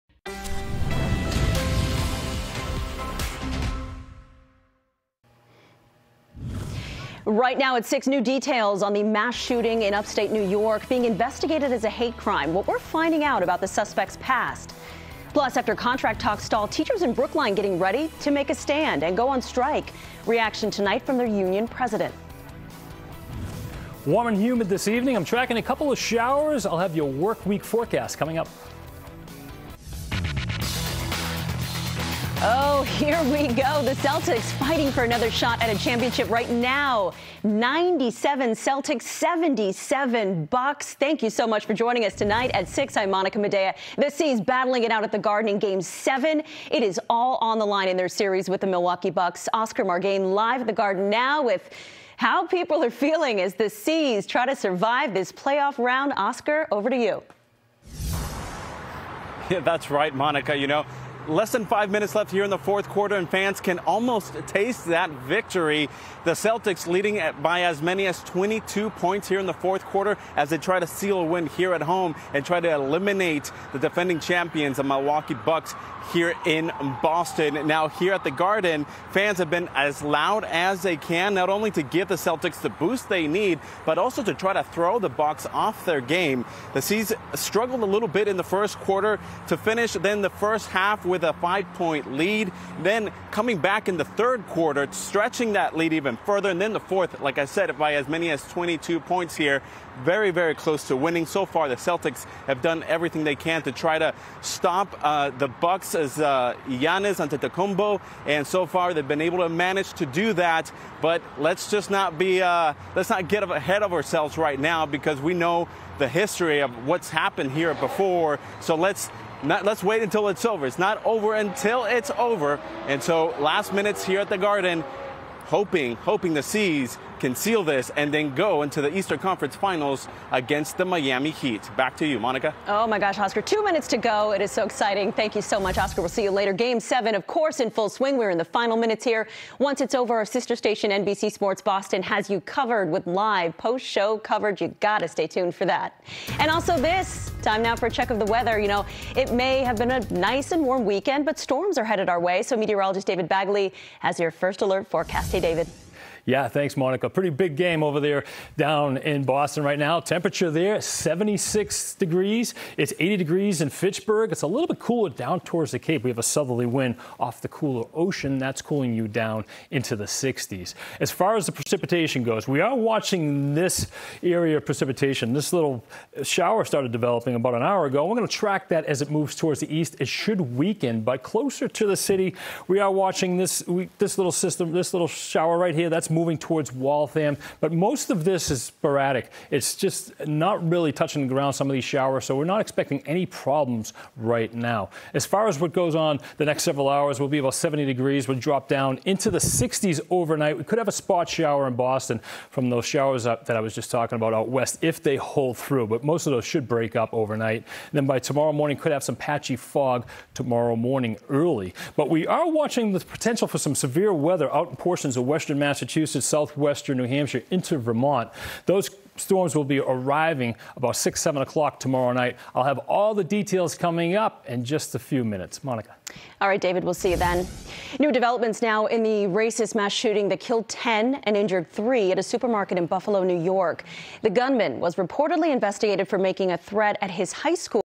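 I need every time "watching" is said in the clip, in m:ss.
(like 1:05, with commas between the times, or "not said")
2:52, 3:02, 3:32.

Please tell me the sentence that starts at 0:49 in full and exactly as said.
Oscar Margain live at the Garden now with how people are feeling as the C's try to survive this playoff round.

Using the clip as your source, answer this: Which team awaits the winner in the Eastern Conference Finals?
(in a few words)
Miami Heat.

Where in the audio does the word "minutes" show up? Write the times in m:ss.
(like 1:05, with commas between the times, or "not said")
1:01, 2:03, 2:13, 2:18, 3:45.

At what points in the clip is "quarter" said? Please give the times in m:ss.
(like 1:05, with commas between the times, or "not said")
1:02, 1:09, 1:28, 1:34.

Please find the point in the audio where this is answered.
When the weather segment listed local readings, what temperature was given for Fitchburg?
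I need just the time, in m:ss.
2:42.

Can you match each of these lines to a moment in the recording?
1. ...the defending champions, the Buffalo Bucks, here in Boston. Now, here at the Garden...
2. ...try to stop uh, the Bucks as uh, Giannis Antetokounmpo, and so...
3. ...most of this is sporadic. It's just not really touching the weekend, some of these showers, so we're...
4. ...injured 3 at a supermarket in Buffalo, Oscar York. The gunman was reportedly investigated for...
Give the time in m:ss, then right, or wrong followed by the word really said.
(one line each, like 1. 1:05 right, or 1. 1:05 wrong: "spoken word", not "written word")
1. 1:13 wrong: "Milwaukee", not "Buffalo"
2. 1:43 right
3. 3:07 wrong: "ground", not "weekend"
4. 3:51 wrong: "New", not "Oscar".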